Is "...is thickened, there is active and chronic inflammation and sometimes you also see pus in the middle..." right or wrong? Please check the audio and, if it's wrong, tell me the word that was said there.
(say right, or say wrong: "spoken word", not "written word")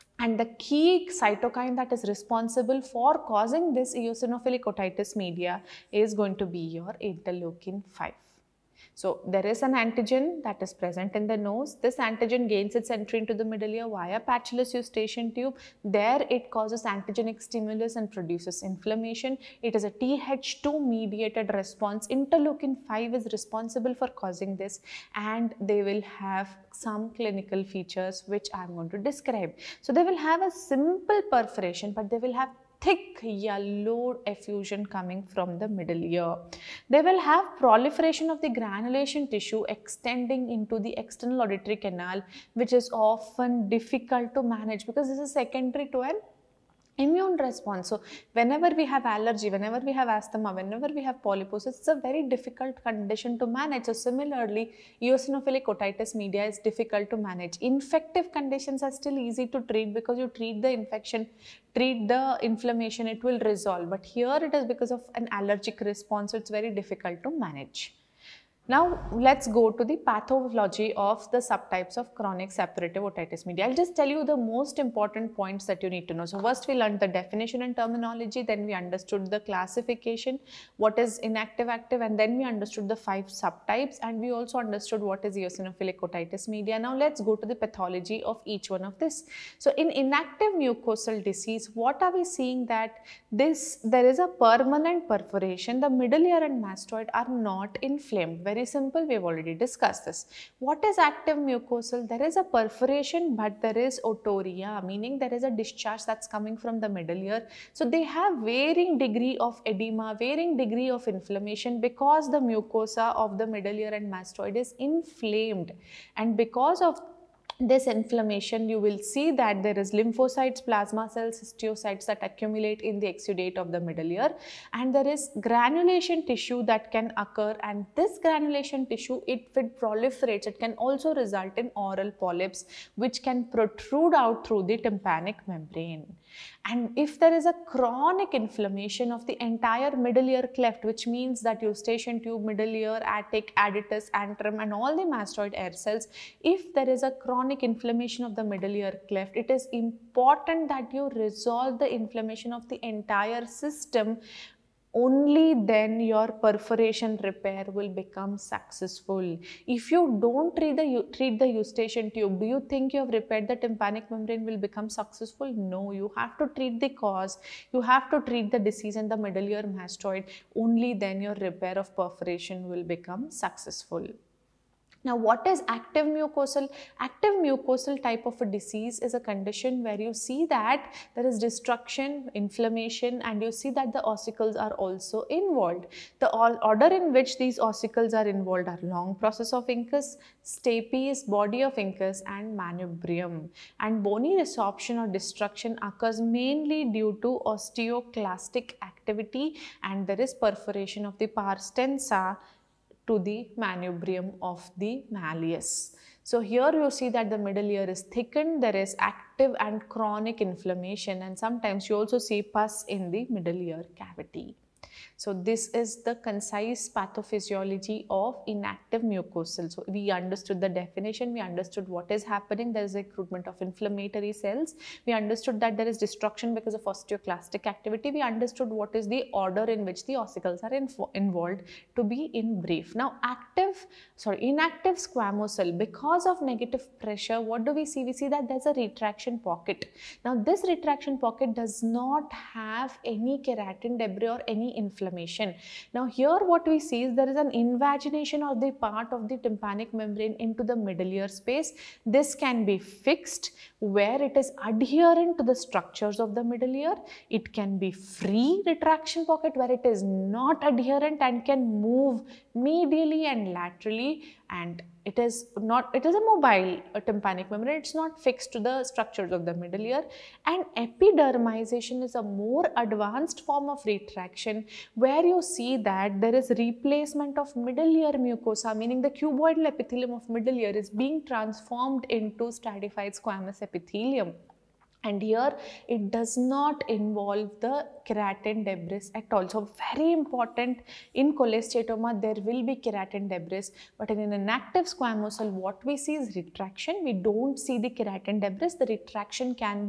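right.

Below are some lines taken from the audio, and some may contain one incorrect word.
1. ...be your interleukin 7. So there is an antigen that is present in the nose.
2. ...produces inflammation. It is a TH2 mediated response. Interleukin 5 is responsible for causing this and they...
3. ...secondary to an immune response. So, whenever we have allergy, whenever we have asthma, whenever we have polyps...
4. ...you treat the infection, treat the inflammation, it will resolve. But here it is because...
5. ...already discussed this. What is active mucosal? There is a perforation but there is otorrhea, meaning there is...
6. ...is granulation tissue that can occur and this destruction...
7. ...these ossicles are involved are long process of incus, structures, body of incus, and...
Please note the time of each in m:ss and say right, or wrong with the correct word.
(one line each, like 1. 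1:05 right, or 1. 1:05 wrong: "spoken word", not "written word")
1. 0:06 wrong: "5", not "7"
2. 0:18 right
3. 0:45 right
4. 1:00 right
5. 1:39 right
6. 2:05 wrong: "granulation", not "destruction"
7. 3:07 wrong: "stapes", not "structures".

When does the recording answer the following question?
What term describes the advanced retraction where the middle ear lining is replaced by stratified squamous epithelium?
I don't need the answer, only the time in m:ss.
4:30.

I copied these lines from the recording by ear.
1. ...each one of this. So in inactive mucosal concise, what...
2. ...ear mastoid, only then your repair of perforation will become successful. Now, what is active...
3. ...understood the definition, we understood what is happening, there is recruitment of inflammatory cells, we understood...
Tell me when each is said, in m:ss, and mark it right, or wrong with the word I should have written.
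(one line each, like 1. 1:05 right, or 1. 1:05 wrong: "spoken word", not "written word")
1. 1:28 wrong: "disease", not "concise"
2. 2:49 right
3. 3:40 right.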